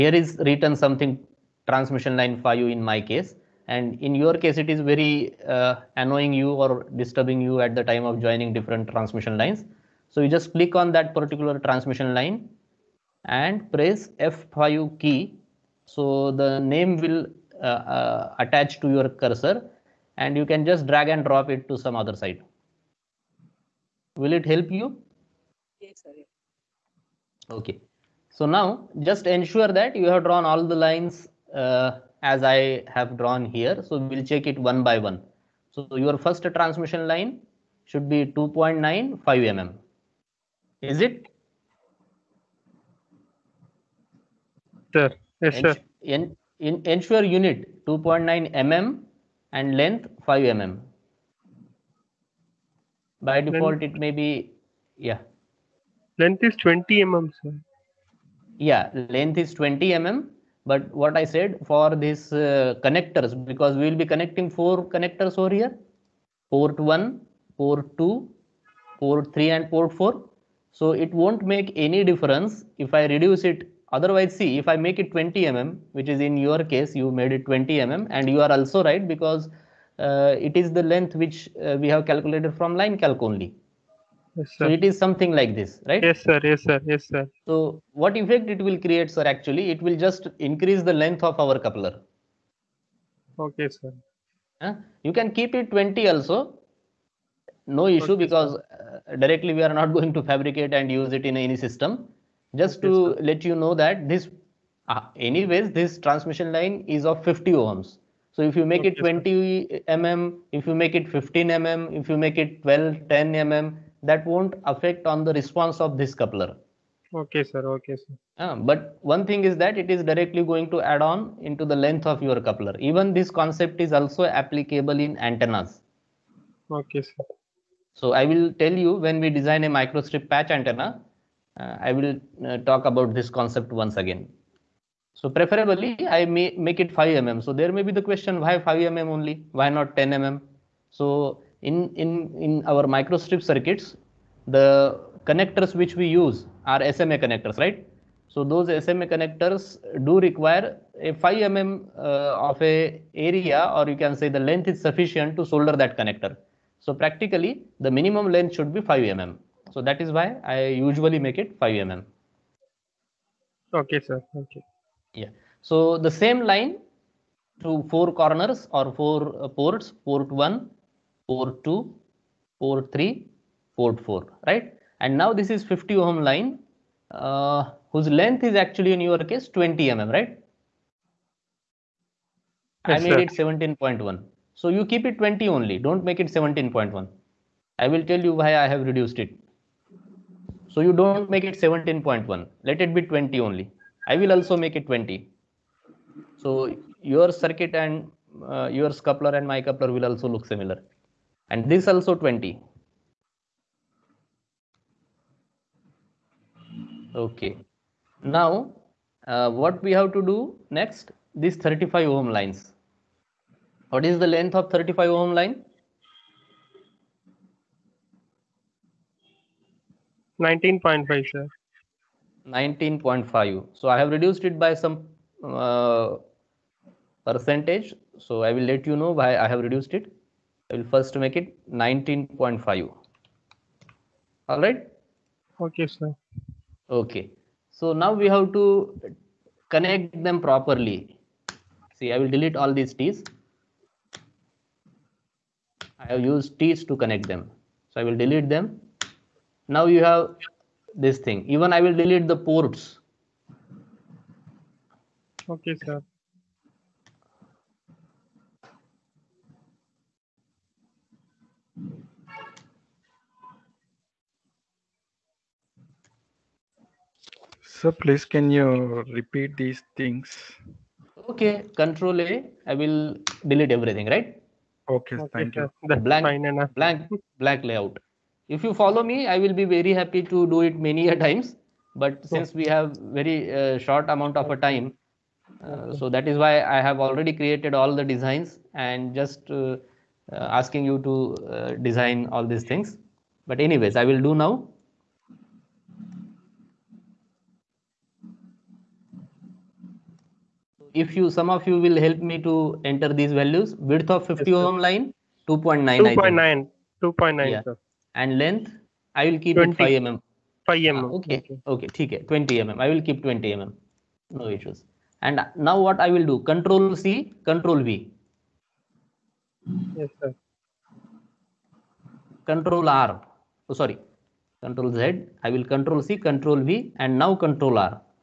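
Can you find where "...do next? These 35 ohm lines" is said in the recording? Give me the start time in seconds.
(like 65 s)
210 s.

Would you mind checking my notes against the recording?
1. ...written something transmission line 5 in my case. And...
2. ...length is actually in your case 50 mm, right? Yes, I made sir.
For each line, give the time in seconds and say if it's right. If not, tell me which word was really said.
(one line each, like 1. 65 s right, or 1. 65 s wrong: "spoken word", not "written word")
1. 0 s right
2. 178 s wrong: "20", not "50".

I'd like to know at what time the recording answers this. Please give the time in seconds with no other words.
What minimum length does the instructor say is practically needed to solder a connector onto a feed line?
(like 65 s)
157 s.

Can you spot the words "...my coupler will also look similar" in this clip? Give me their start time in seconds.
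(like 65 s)
199 s.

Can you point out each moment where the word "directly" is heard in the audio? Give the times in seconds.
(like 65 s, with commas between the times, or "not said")
99 s, 120 s.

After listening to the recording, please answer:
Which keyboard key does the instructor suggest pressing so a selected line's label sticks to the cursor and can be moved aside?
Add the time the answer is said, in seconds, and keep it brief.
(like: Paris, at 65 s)
F5, at 14 s.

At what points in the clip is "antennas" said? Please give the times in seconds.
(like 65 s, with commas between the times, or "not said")
125 s, 130 s.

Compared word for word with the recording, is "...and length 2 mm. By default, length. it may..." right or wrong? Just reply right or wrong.
wrong.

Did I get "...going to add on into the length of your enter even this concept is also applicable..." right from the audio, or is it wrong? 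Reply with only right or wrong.
wrong.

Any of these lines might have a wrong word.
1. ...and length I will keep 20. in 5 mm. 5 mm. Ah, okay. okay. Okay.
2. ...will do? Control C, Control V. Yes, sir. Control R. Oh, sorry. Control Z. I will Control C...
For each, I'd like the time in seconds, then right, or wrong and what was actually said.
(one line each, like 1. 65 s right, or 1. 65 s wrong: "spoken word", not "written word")
1. 308 s right
2. 316 s right.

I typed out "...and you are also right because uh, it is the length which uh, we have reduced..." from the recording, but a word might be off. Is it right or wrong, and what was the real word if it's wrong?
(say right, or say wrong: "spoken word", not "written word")
wrong: "calculated", not "reduced".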